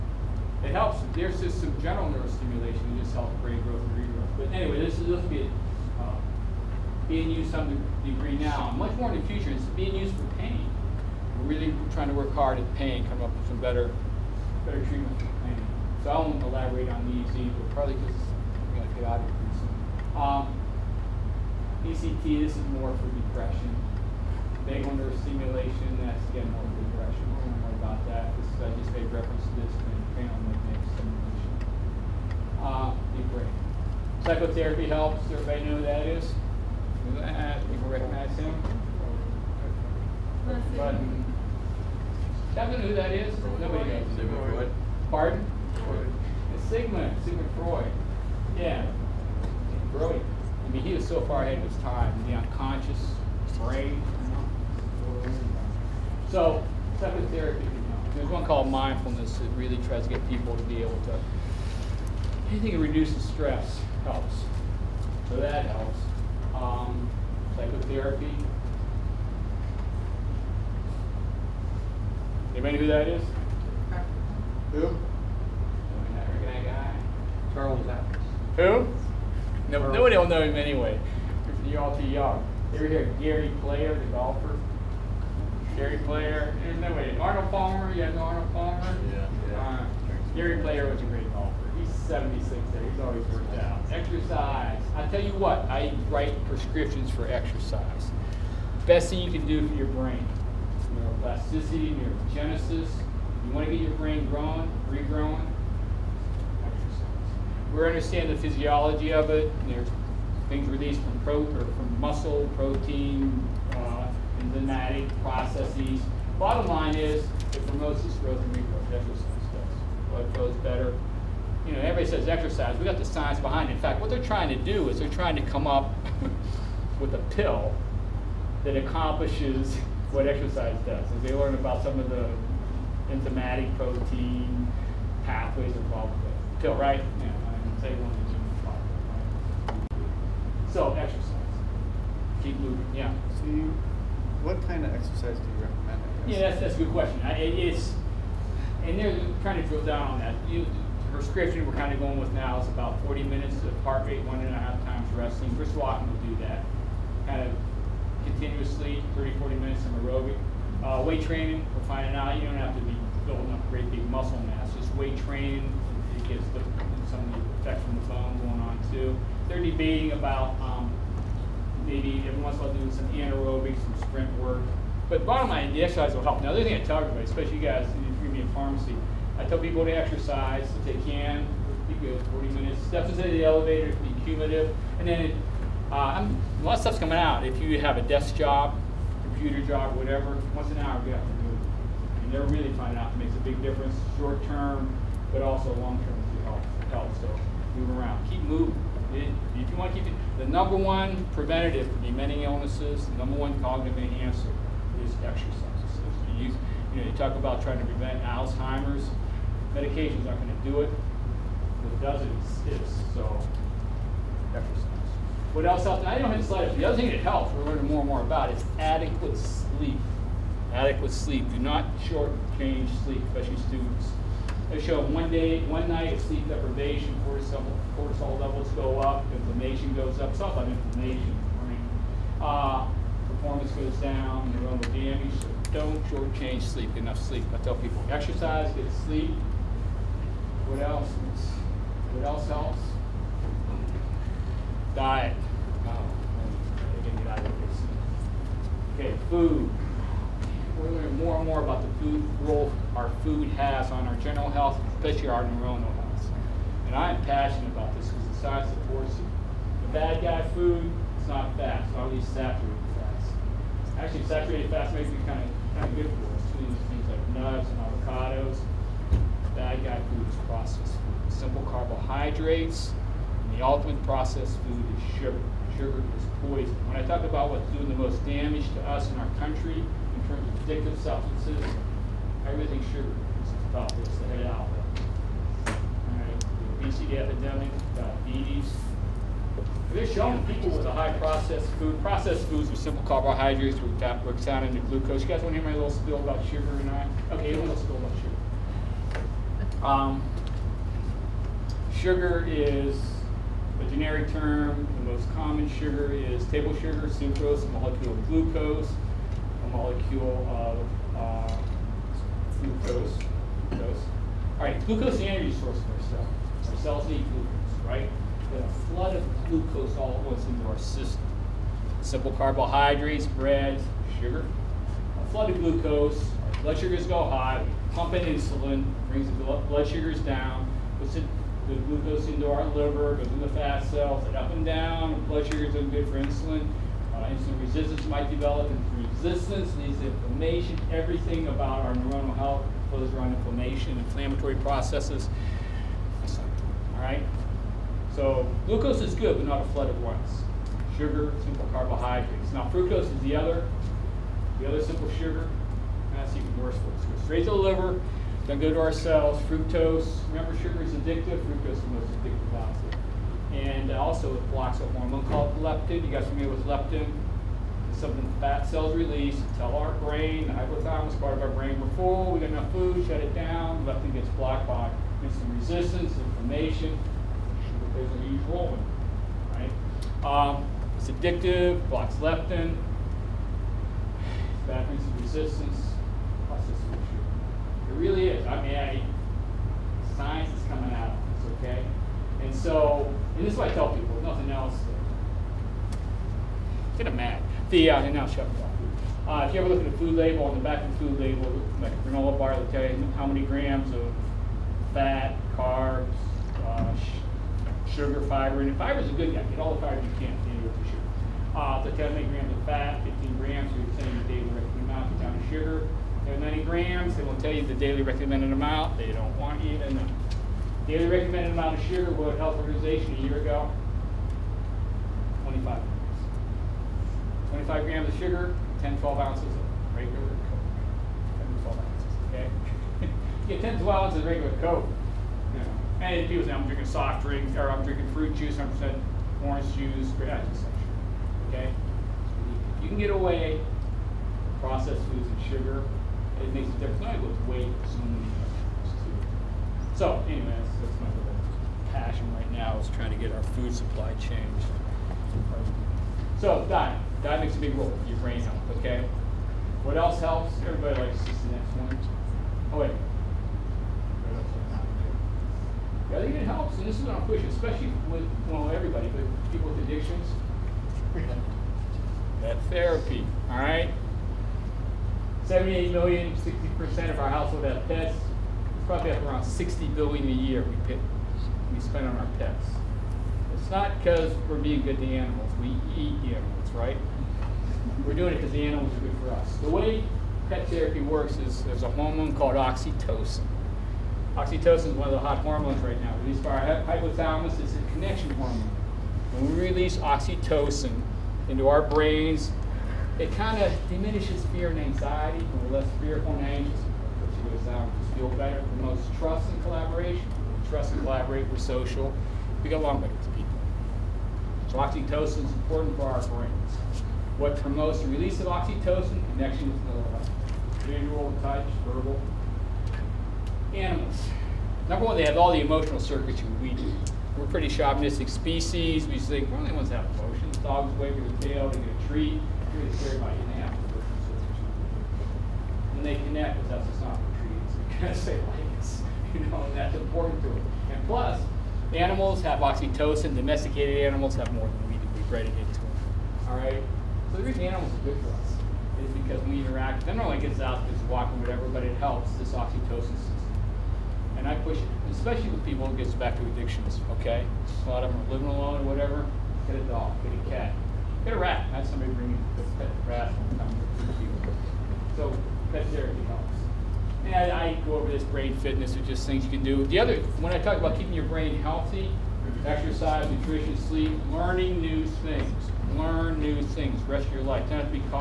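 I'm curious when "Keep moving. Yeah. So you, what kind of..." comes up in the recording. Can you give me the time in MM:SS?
02:22.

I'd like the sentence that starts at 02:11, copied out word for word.
Is they learn about some of the enzymatic protein pathways involved with it.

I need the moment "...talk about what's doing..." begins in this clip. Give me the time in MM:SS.
04:37.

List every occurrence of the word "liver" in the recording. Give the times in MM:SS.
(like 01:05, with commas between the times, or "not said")
05:32, 05:57.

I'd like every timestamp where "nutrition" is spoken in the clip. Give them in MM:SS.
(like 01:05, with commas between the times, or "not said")
09:33.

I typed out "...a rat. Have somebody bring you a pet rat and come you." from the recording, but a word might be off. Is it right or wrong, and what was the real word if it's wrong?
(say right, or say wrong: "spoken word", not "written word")
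right.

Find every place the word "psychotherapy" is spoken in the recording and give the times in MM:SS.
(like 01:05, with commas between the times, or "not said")
00:34, 00:56, 01:07.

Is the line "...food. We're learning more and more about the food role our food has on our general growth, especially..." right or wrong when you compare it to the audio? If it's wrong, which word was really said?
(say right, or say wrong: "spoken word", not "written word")
wrong: "health", not "growth".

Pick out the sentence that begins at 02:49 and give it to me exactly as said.
They're debating about um, maybe everyone's while doing some anaerobic, some sprint work.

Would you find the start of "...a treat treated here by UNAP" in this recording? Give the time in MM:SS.
08:51.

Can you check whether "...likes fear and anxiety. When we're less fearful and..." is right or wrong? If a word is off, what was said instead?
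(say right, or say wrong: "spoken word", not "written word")
wrong: "diminishes", not "likes".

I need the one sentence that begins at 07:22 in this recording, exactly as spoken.
you can get away processed foods and sugar it makes a difference.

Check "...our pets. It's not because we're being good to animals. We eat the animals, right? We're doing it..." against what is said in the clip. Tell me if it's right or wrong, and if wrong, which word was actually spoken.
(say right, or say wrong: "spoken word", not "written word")
right.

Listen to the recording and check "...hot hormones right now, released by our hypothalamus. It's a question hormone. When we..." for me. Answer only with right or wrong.
wrong.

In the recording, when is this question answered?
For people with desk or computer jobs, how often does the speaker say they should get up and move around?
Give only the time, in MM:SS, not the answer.
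03:10.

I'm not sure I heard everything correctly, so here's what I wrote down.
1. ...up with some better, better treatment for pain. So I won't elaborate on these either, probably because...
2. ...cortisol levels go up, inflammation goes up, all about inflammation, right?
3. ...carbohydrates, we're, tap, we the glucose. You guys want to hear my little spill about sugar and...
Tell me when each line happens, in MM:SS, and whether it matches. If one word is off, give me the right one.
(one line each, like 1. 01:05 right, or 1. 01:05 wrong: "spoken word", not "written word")
1. 00:13 right
2. 03:47 right
3. 04:53 right.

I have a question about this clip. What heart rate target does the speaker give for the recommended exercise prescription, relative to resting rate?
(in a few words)
1.5 times resting.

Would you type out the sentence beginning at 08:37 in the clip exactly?
What promotes the release of oxytocin?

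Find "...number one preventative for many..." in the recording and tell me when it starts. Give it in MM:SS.
03:20.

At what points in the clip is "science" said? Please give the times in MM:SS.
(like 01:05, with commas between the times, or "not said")
02:03, 04:18, 06:30.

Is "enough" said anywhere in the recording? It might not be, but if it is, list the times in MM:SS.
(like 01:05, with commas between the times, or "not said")
03:56, 06:12.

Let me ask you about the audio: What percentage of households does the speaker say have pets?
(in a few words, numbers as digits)
60%.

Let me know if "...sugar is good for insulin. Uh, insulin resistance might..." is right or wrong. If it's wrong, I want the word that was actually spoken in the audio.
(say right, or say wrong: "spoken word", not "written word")
right.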